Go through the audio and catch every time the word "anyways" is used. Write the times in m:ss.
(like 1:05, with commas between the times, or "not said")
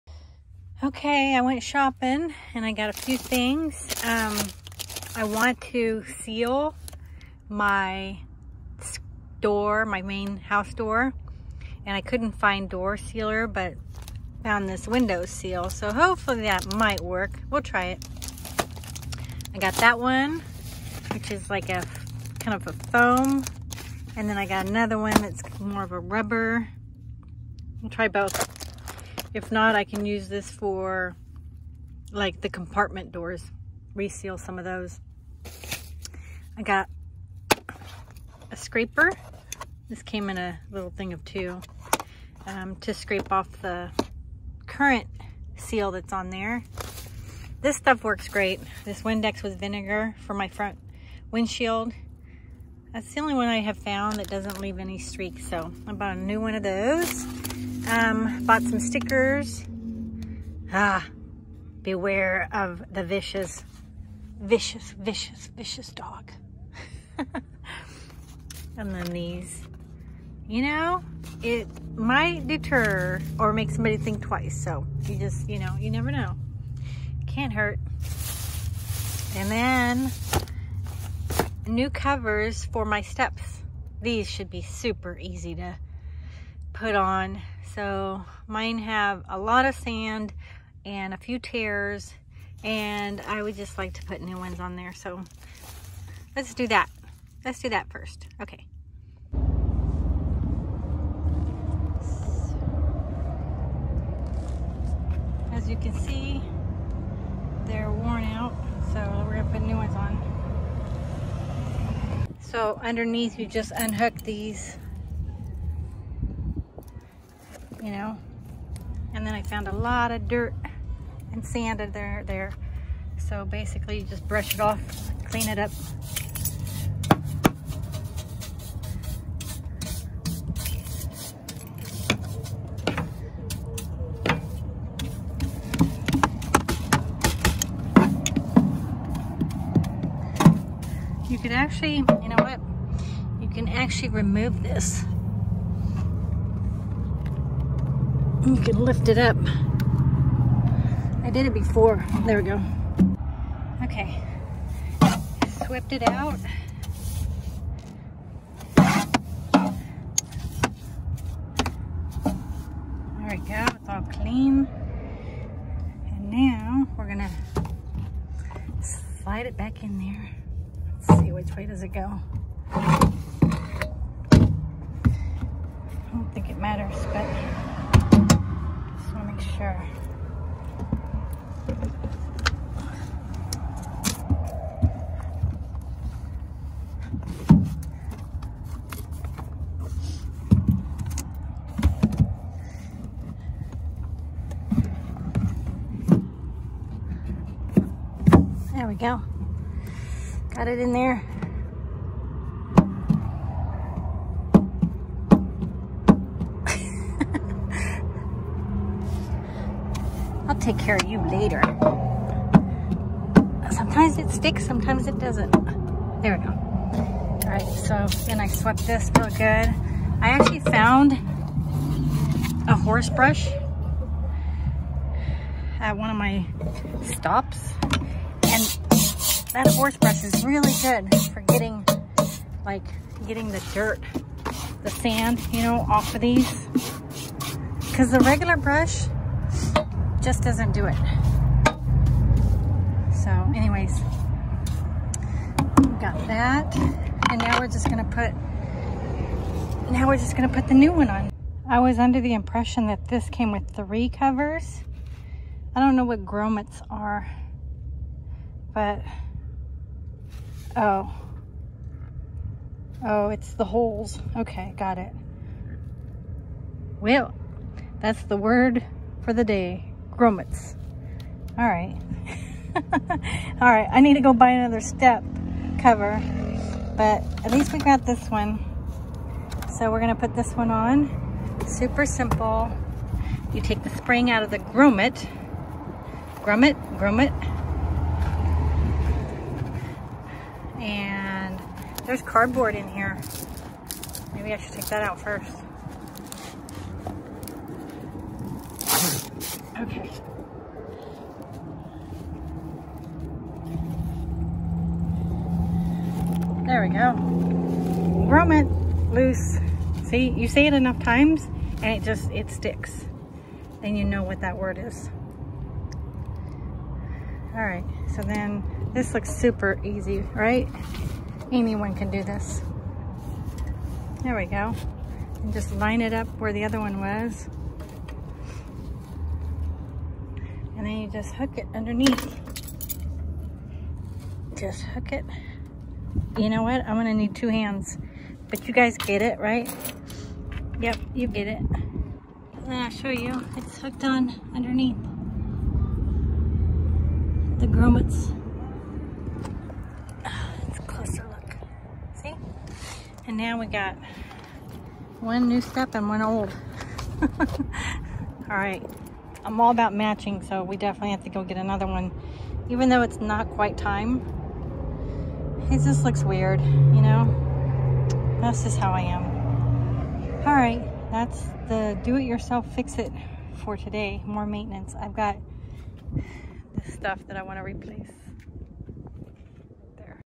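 4:03.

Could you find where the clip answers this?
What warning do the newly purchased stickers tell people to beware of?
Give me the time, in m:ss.
1:05.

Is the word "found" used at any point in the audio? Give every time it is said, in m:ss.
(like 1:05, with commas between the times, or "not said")
0:14, 0:53, 1:59, 3:40.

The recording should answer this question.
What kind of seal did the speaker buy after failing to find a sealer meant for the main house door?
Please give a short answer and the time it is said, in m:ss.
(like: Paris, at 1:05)
window seal, at 0:14.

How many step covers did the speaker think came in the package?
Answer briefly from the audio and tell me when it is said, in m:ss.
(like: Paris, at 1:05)
3, at 4:13.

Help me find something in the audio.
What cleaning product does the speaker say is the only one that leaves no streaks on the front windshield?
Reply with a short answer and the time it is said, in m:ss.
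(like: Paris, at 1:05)
Windex with vinegar, at 0:49.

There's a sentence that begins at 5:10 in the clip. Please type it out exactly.
See, you say it enough times and it just, it sticks.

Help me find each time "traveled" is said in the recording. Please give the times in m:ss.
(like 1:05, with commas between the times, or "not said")
not said.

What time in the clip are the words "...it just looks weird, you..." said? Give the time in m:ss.
6:05.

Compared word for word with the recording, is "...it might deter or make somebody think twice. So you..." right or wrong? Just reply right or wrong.
right.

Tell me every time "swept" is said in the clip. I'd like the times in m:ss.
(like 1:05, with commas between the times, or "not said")
2:35, 3:38.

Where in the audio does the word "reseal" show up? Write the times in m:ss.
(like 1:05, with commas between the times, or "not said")
0:33.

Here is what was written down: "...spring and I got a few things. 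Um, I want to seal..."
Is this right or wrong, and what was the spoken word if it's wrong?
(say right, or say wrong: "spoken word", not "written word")
wrong: "shopping", not "spring".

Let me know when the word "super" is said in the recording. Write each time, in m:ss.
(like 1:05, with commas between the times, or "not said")
1:24, 4:41, 5:19.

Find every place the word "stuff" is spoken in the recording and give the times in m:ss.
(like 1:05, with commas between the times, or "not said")
0:47, 6:16.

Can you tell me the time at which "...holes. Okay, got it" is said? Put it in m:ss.
4:23.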